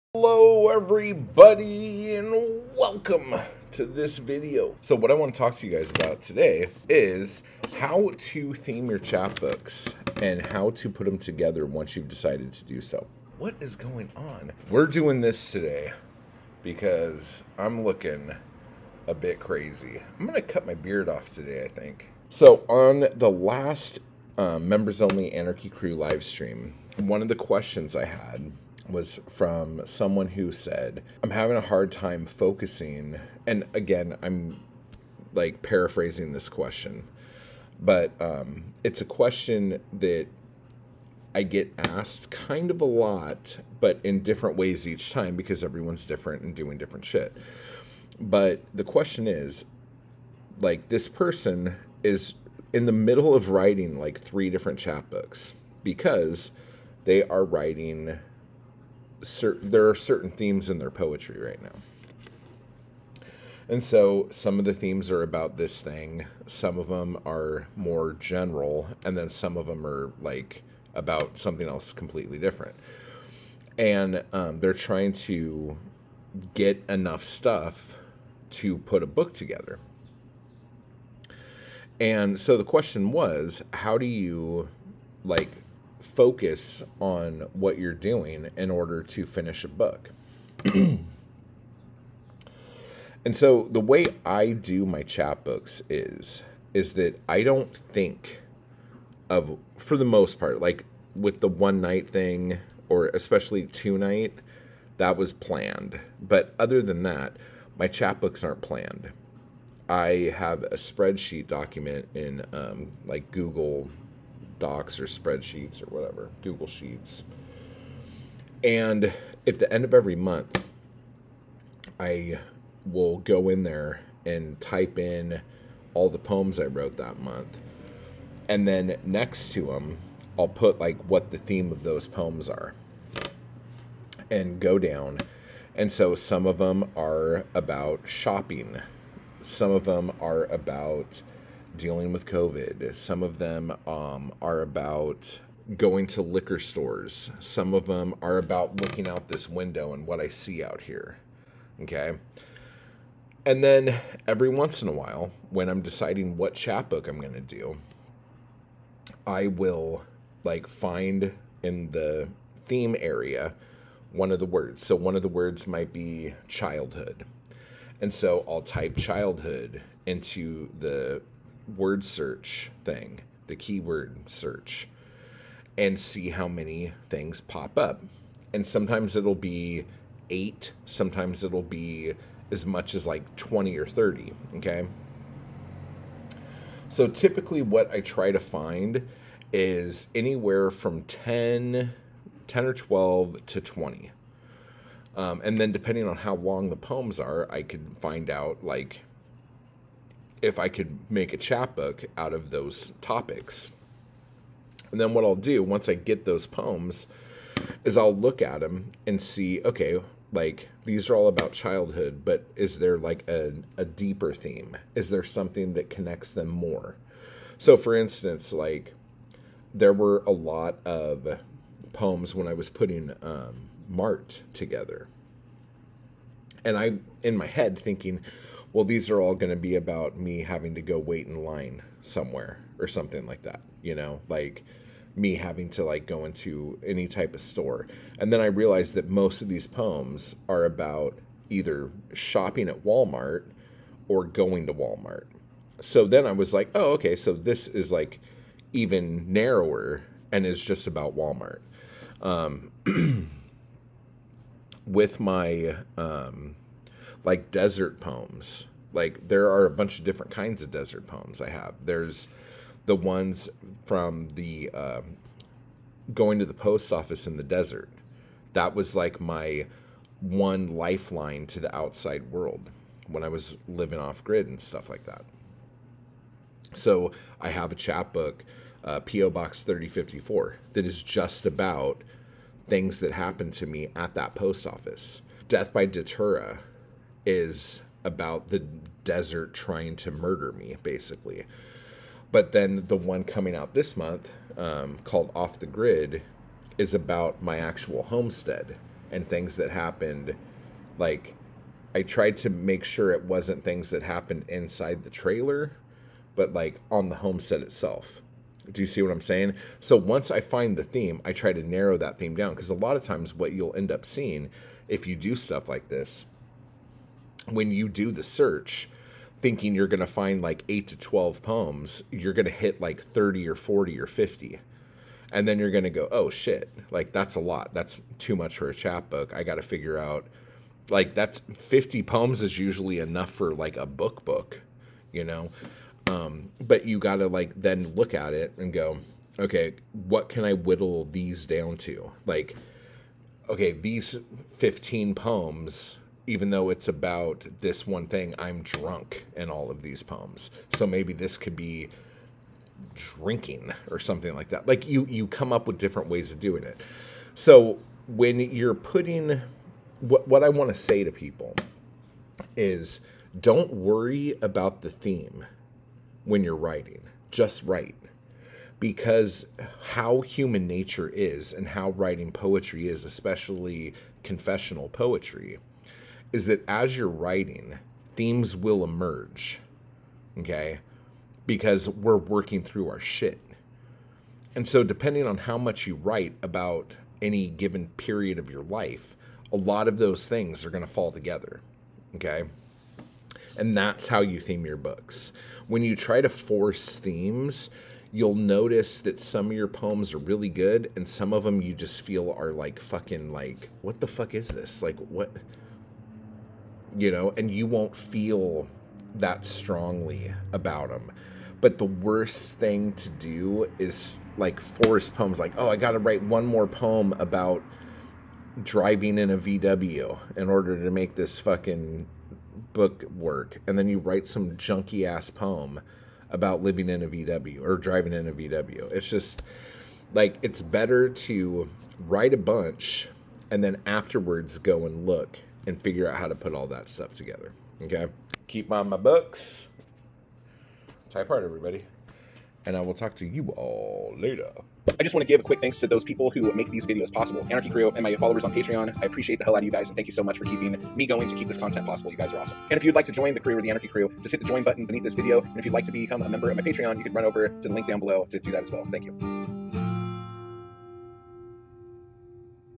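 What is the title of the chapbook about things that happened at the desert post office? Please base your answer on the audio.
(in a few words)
P.O. Box 3054.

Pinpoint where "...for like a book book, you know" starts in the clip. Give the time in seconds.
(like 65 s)
333 s.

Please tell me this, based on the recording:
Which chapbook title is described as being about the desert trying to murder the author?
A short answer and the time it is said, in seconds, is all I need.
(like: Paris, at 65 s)
Death by Datura, at 285 s.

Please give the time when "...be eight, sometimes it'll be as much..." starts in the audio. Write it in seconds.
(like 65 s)
179 s.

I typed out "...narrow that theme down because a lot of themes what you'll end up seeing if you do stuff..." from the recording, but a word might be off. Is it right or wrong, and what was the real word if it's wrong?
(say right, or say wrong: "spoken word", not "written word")
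wrong: "times", not "themes".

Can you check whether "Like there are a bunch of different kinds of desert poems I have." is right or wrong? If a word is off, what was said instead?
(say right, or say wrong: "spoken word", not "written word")
right.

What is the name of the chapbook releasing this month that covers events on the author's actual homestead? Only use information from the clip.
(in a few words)
Off the Grid.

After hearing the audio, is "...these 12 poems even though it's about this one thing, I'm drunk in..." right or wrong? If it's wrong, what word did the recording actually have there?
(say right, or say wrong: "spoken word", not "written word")
wrong: "15", not "12".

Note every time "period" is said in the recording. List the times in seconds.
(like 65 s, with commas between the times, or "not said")
387 s.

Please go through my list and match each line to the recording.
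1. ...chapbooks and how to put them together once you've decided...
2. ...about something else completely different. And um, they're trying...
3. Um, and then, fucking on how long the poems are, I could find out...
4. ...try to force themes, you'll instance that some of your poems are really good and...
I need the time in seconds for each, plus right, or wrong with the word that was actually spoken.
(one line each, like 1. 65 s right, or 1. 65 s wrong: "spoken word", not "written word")
1. 8 s right
2. 70 s right
3. 195 s wrong: "depending", not "fucking"
4. 395 s wrong: "notice", not "instance".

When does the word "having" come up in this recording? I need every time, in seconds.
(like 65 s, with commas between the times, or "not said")
31 s, 230 s, 235 s.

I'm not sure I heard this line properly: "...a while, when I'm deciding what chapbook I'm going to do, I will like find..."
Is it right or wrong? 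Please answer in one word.
right.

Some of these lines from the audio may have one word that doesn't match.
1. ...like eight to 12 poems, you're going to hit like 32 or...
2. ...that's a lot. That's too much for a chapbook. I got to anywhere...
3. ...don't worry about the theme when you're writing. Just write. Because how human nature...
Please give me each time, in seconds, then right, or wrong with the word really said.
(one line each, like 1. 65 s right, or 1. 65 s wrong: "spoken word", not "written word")
1. 320 s wrong: "30", not "32"
2. 327 s wrong: "figure", not "anywhere"
3. 363 s right.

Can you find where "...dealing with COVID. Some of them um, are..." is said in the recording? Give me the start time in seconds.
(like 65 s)
141 s.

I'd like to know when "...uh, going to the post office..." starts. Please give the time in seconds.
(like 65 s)
264 s.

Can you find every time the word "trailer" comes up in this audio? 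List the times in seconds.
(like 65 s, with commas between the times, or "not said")
305 s.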